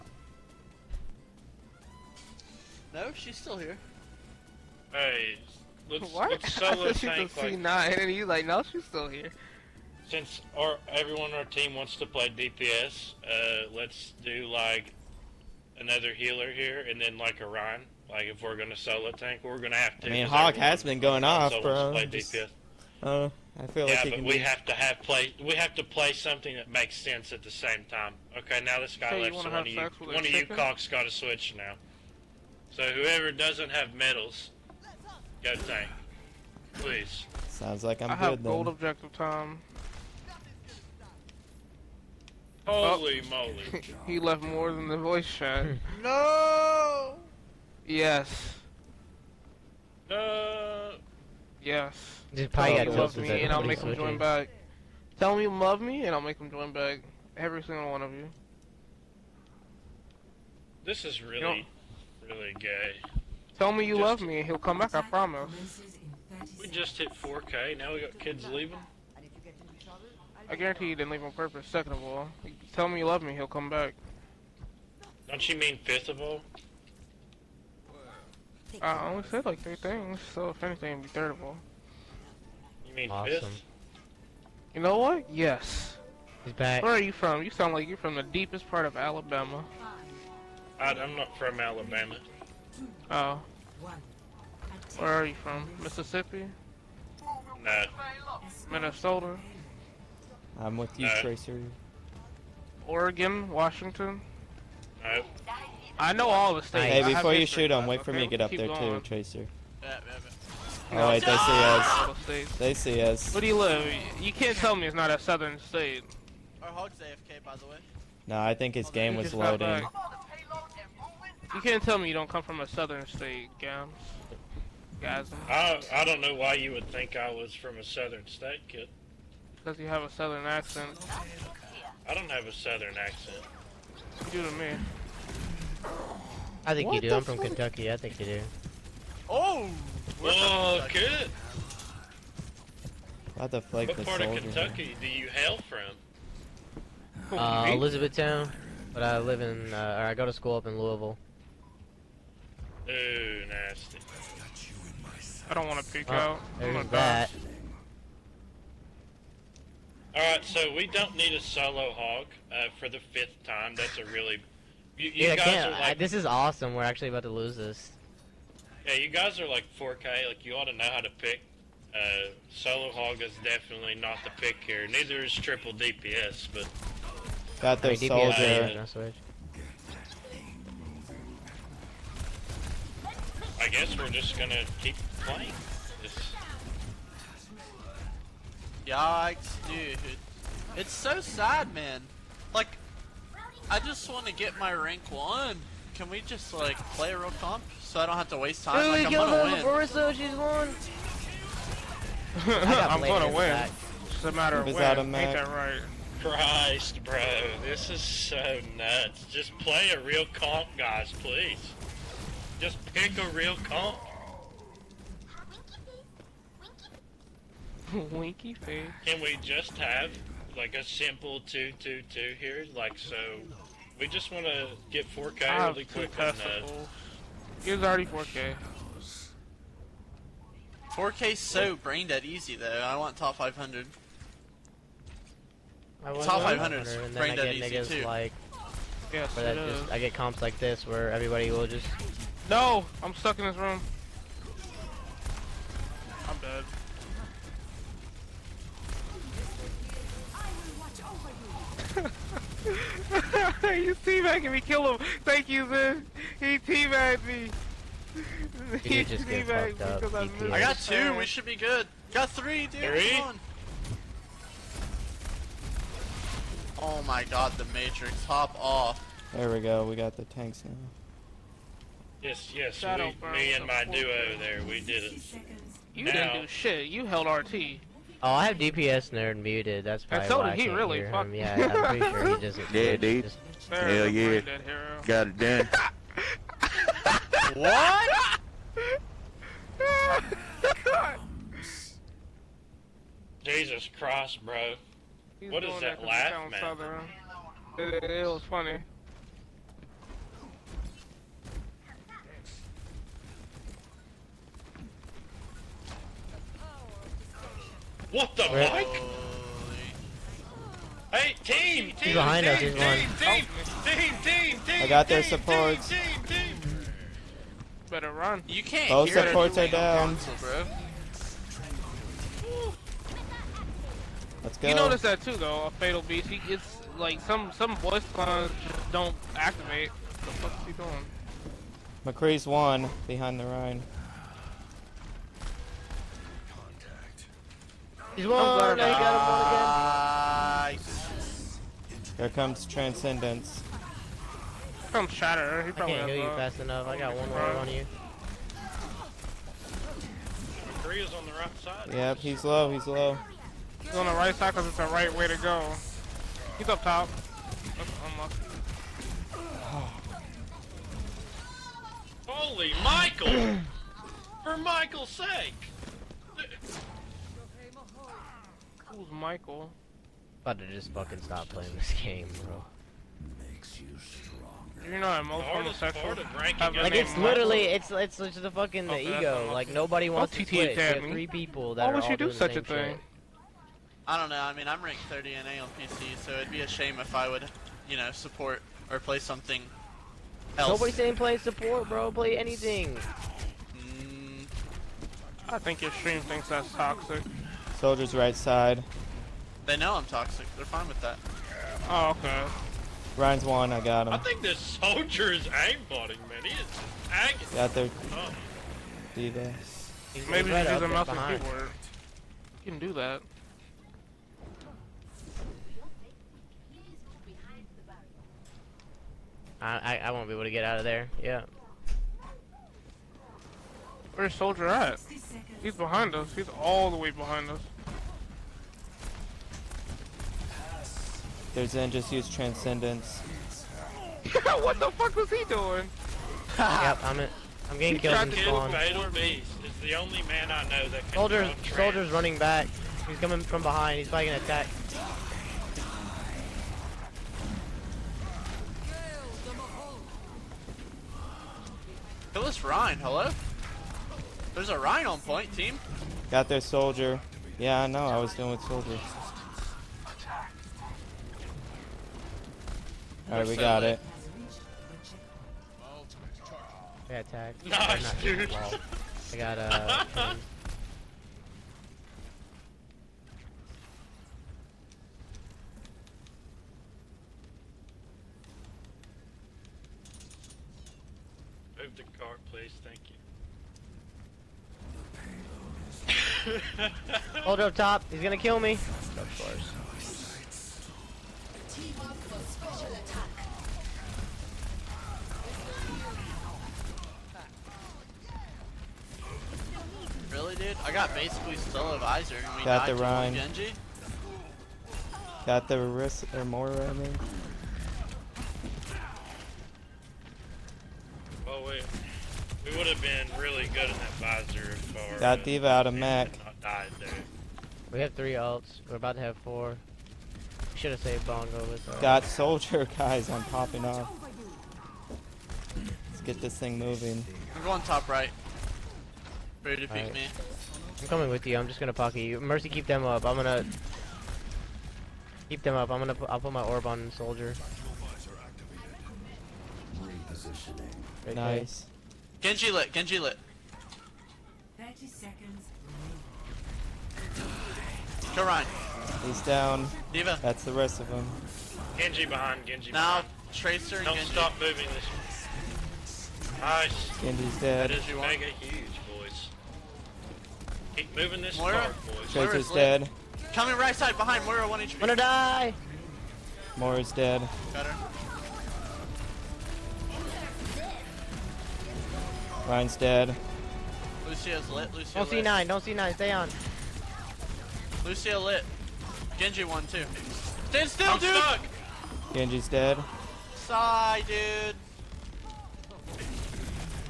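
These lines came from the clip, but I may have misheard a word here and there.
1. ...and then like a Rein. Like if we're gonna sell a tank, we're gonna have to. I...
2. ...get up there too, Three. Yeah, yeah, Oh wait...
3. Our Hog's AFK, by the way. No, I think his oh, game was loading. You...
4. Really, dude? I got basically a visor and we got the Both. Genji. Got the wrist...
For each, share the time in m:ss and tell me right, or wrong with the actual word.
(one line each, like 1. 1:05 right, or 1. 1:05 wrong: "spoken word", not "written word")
1. 0:16 right
2. 1:48 wrong: "Tracer", not "Three"
3. 1:56 right
4. 8:20 wrong: "Rein", not "Both".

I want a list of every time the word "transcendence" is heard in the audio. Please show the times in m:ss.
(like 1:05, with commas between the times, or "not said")
5:42, 7:12.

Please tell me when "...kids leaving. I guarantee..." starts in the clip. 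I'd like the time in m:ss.
1:08.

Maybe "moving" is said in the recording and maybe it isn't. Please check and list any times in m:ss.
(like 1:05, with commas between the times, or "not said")
8:46, 9:14, 9:21.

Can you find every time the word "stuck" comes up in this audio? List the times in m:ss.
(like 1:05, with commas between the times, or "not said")
4:03, 9:41.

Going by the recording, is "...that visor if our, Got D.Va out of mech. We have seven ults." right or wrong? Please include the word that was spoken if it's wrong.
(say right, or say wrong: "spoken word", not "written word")
wrong: "three", not "seven".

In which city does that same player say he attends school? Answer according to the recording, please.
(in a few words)
Louisville.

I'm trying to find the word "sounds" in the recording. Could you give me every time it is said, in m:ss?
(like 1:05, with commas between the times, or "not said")
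0:37, 1:27.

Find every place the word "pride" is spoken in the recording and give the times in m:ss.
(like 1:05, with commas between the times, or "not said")
not said.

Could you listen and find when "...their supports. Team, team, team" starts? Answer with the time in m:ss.
5:15.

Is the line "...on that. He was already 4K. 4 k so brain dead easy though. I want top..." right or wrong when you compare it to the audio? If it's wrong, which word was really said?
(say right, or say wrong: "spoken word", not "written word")
right.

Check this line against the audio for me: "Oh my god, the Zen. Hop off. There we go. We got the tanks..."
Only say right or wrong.
wrong.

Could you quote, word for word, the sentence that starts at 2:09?
Because you have a southern accent.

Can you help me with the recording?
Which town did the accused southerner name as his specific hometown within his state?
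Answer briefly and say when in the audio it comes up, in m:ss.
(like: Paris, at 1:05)
Elizabethtown, at 2:27.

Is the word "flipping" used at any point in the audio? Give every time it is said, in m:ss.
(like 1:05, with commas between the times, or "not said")
not said.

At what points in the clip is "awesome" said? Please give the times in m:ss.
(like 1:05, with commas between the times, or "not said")
1:23, 2:46.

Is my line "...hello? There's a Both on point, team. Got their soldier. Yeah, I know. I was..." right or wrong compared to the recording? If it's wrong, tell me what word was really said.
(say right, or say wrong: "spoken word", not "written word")
wrong: "Rhino", not "Both".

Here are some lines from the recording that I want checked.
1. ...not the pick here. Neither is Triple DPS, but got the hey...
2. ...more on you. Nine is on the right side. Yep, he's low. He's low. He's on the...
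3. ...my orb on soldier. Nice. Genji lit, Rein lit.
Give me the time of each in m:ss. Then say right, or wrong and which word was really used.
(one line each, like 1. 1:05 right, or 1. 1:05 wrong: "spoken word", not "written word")
1. 2:53 right
2. 5:47 wrong: "Three", not "Nine"
3. 8:56 wrong: "Genji", not "Rein".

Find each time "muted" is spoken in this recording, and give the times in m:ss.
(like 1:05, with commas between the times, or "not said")
4:39.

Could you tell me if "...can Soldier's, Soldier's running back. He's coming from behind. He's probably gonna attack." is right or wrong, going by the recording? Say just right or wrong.
right.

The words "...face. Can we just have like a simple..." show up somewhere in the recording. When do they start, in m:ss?
3:38.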